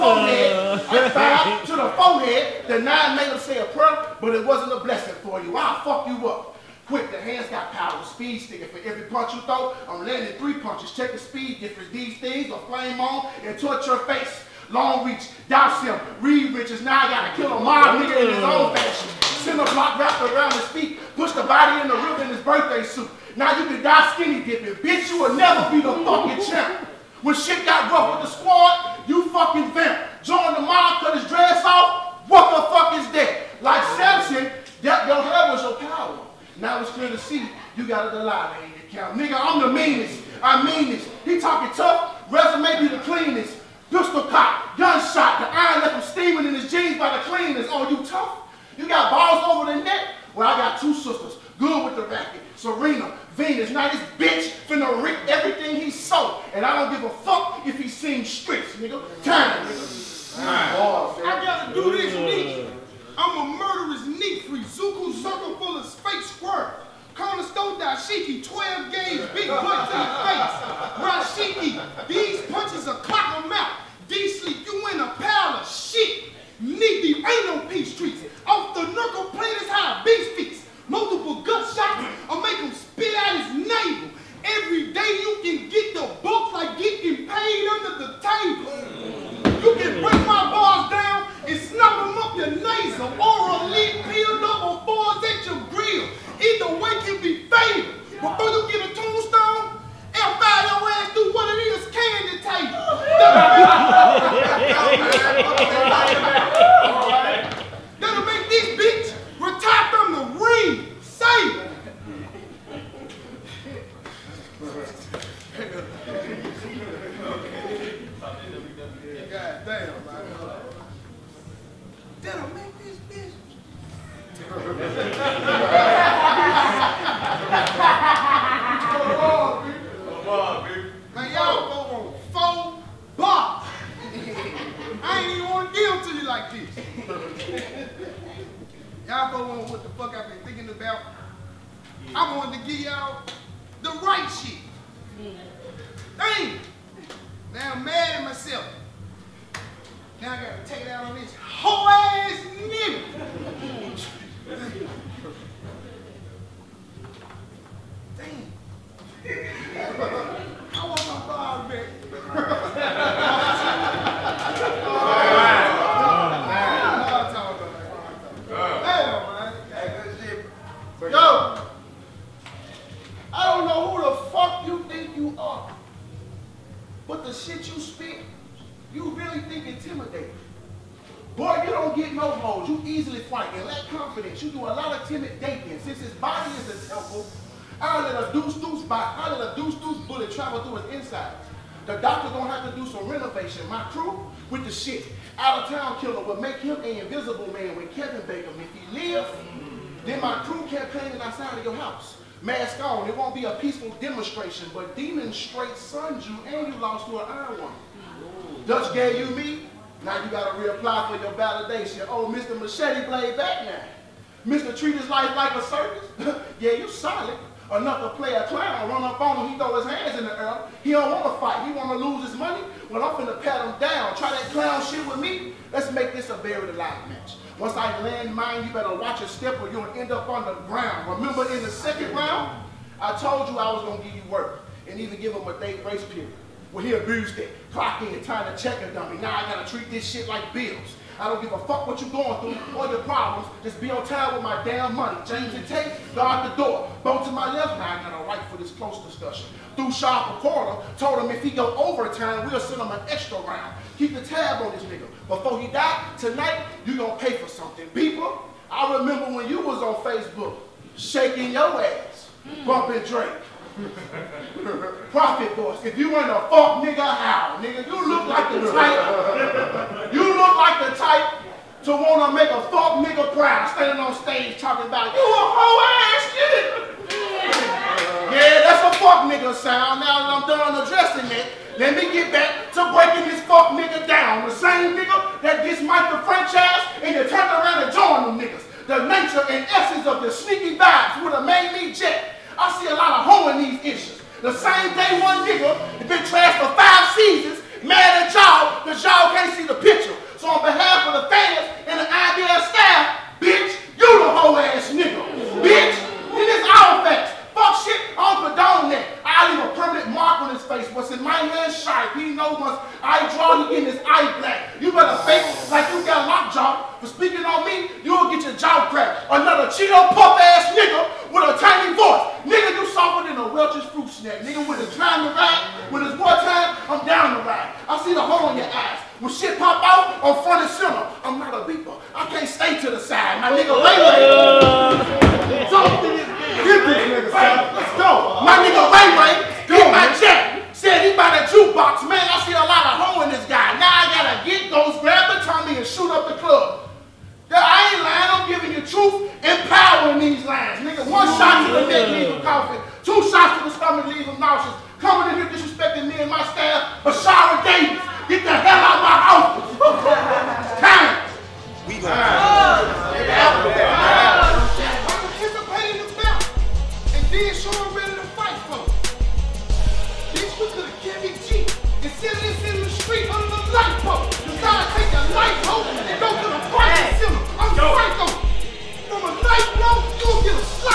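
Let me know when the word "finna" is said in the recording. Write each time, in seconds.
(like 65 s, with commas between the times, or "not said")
54 s, 223 s.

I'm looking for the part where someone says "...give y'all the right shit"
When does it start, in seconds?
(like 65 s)
142 s.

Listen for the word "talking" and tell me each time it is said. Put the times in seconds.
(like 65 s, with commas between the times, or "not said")
41 s, 274 s.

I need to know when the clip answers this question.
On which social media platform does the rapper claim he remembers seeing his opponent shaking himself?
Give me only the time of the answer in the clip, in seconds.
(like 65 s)
259 s.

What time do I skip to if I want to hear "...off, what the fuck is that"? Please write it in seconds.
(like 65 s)
31 s.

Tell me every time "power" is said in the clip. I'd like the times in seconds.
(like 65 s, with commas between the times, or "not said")
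7 s, 35 s.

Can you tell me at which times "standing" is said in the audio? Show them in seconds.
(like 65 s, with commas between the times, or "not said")
273 s.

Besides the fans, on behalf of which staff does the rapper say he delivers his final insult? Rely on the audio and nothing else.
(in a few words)
IBS staff.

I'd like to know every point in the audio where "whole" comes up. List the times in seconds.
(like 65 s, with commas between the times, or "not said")
275 s, 304 s.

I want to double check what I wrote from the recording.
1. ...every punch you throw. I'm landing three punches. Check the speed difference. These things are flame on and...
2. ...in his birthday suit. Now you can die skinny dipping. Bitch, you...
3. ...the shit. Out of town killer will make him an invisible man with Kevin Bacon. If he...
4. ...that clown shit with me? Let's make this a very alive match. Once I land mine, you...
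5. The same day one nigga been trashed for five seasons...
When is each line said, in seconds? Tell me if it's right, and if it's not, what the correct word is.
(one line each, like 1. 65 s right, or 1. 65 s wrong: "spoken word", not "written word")
1. 8 s right
2. 22 s right
3. 194 s right
4. 224 s right
5. 294 s right.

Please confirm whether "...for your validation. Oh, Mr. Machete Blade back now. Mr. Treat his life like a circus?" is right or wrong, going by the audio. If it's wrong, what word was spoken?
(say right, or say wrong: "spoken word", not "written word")
right.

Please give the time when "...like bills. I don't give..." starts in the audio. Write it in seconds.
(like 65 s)
240 s.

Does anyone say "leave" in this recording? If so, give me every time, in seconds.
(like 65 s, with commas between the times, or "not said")
309 s.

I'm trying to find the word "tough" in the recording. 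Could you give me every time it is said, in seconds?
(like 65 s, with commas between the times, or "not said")
41 s, 48 s.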